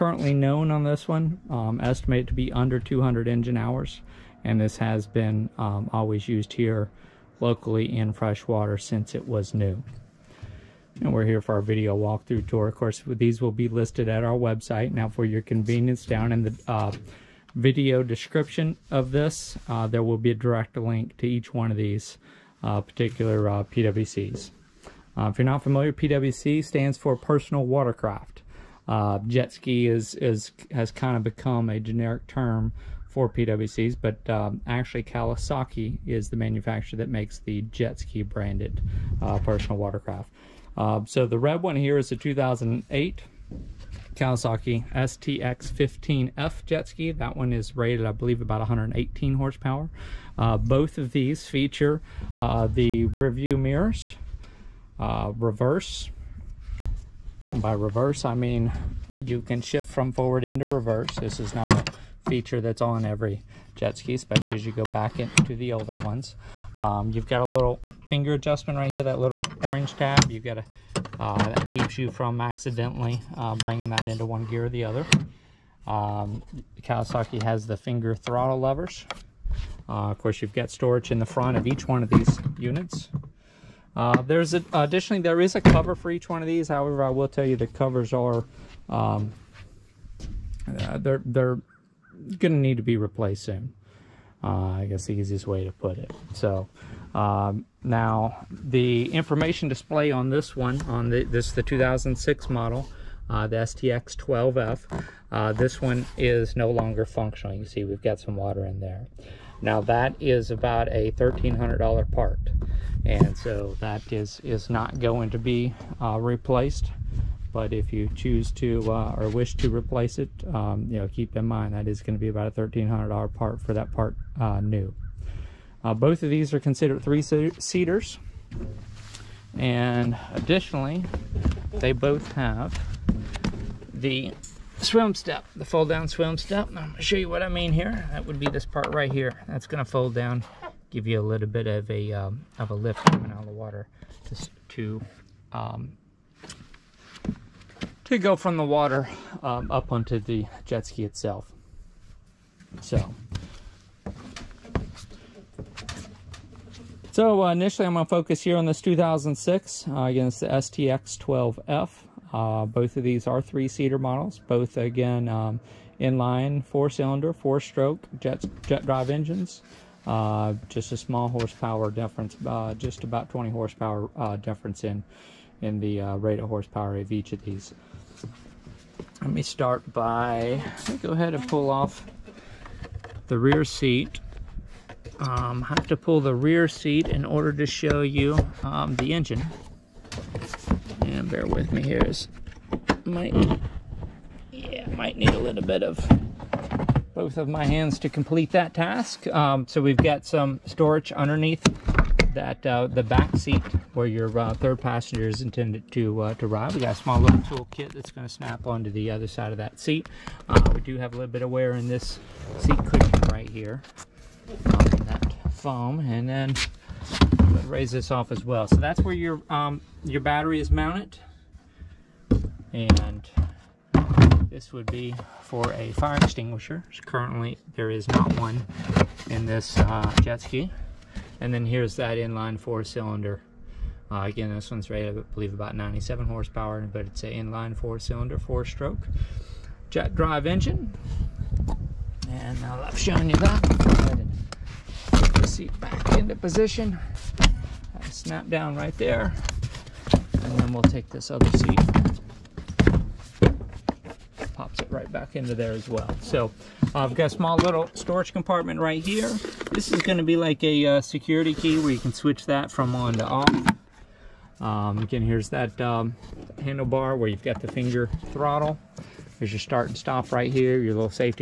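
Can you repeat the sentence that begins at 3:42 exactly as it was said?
And this would be for a fire extinguisher.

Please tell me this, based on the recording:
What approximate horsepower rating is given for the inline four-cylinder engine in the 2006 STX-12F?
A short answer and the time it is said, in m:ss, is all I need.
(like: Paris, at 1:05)
97, at 3:55.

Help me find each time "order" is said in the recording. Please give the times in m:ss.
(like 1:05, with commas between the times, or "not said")
3:07.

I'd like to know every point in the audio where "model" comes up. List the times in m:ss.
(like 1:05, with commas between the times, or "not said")
1:42, 2:43.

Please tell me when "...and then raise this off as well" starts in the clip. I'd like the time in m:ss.
3:35.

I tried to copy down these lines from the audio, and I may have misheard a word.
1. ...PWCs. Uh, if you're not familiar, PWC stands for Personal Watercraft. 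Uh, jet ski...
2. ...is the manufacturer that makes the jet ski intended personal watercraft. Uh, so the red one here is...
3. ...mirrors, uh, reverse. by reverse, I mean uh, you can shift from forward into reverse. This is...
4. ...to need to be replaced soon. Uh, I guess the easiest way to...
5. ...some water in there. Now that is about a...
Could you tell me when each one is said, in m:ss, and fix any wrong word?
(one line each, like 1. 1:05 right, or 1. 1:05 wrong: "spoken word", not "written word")
1. 0:23 right
2. 0:36 wrong: "branded", not "intended"
3. 0:53 right
4. 1:32 right
5. 1:48 right.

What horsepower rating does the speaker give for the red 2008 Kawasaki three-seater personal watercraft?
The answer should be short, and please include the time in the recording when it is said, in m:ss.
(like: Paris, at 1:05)
118, at 0:48.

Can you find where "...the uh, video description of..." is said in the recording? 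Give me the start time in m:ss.
0:16.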